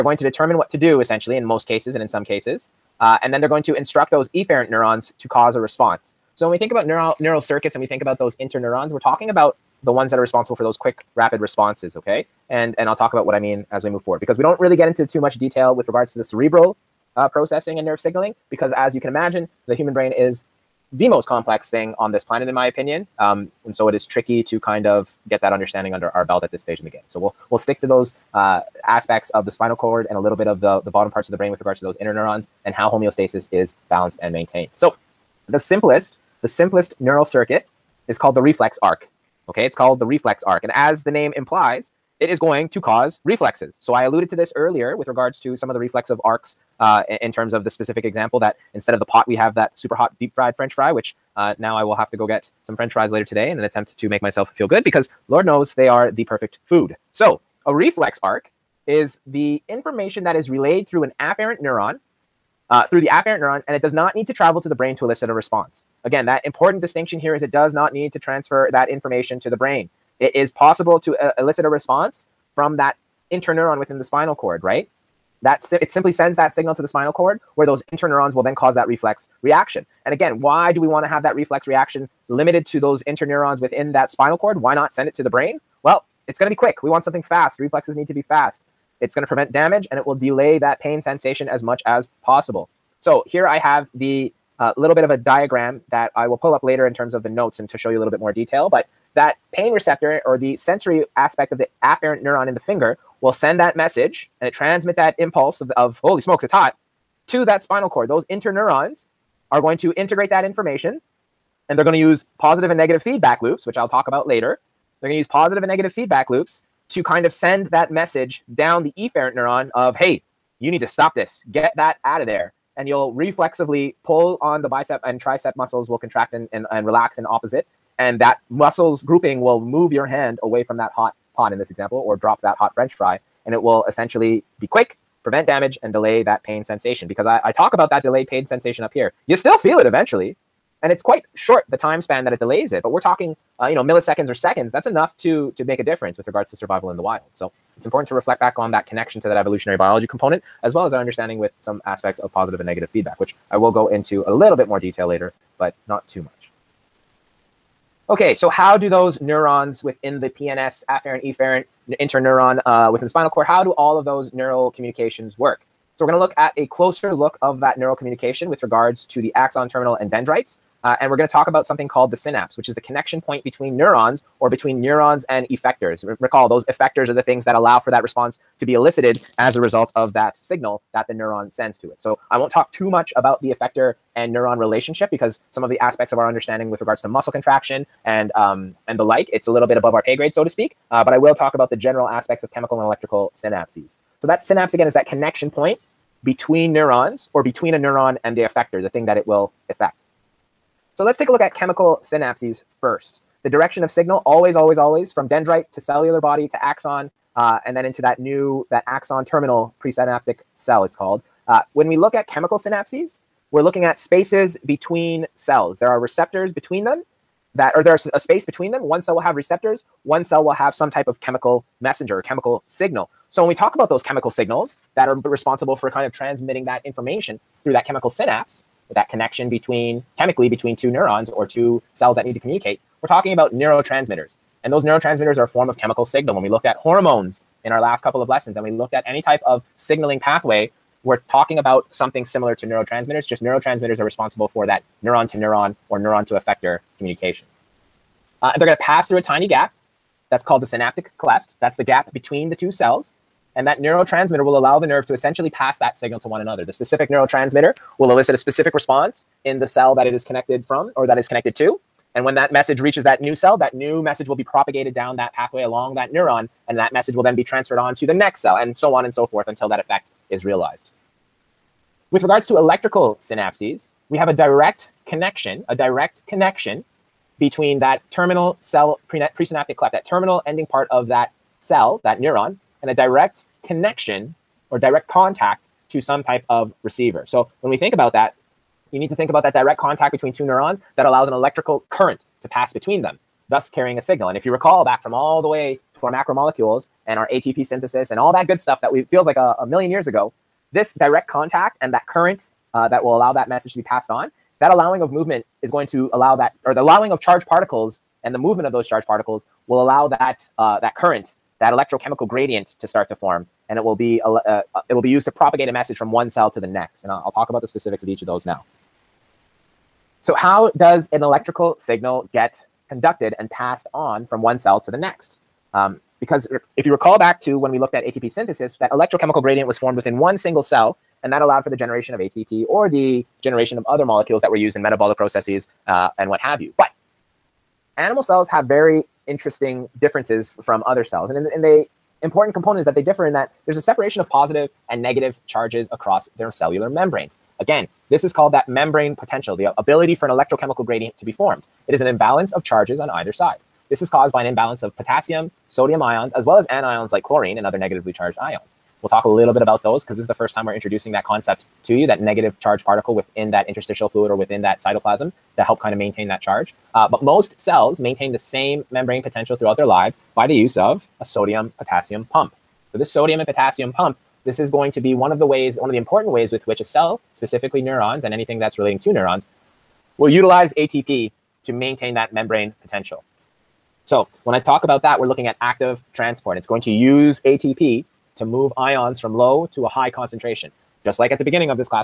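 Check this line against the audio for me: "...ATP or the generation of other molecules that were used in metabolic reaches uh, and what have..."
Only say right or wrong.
wrong.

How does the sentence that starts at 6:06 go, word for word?
Uh, but most cells maintain the same membrane potential throughout their lives by the use of a sodium potassium pump.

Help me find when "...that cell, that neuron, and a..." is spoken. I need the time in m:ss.
4:41.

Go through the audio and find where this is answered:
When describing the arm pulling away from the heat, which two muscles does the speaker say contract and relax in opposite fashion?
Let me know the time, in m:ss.
2:04.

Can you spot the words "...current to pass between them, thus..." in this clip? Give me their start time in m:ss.
4:51.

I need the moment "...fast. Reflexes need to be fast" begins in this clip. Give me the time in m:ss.
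1:27.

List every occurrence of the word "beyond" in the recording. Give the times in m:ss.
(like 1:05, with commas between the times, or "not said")
not said.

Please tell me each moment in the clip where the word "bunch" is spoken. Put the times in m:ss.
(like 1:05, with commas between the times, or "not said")
not said.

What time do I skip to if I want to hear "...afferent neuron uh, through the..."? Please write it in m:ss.
1:01.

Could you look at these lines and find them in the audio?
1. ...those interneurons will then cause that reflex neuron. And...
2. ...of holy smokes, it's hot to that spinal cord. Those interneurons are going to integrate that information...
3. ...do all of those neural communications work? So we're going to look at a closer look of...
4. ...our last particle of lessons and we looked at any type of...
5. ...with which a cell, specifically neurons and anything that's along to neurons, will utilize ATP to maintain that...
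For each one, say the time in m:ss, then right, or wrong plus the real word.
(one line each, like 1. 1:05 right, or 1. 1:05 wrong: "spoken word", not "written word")
1. 1:17 wrong: "reaction", not "neuron"
2. 1:45 right
3. 2:43 right
4. 3:57 wrong: "couple", not "particle"
5. 6:16 wrong: "relating", not "along".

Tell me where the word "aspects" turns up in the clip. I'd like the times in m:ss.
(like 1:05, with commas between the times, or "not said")
0:28, 1:41, 2:31, 3:05, 3:12.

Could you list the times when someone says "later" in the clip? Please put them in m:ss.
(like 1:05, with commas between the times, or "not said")
0:53, 1:36, 1:54, 2:35.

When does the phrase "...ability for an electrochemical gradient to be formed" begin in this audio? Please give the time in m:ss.
5:49.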